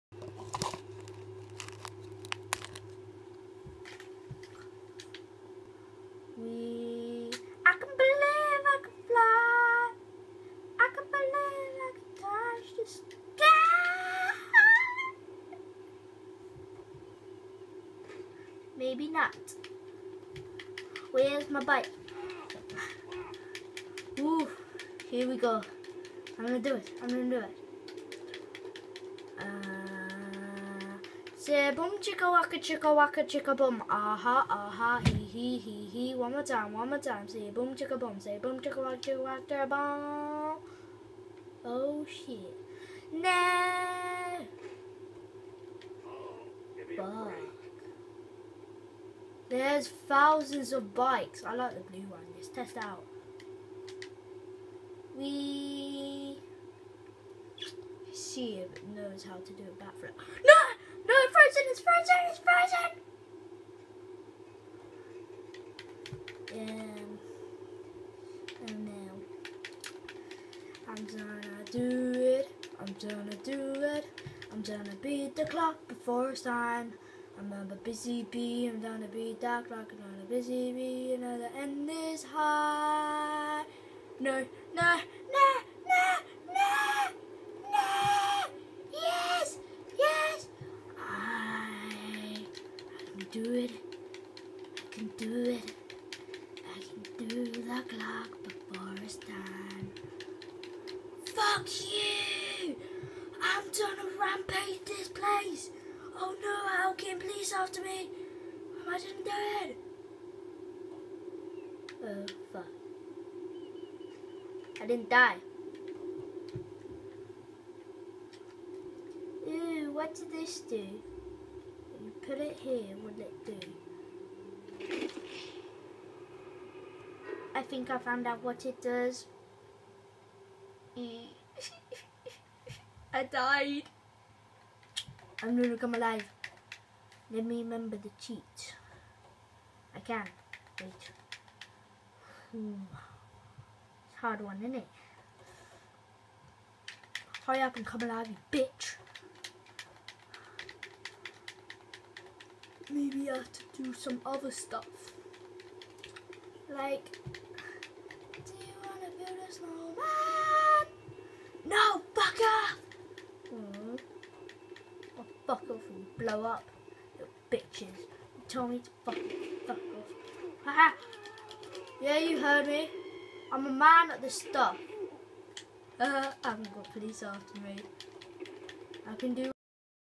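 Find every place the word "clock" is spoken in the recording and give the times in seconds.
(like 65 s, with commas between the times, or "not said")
75 s, 97 s.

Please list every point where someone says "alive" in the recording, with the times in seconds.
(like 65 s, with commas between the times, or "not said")
135 s, 148 s.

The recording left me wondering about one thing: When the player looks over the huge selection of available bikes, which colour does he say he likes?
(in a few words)
blue.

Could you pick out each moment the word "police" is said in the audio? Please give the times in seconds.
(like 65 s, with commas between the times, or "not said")
107 s, 176 s.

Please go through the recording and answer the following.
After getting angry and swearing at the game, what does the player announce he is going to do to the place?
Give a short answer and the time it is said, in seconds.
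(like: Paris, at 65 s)
rampage, at 104 s.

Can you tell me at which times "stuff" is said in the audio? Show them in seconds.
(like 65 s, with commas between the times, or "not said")
154 s, 174 s.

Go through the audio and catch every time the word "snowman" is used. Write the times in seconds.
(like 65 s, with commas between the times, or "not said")
159 s.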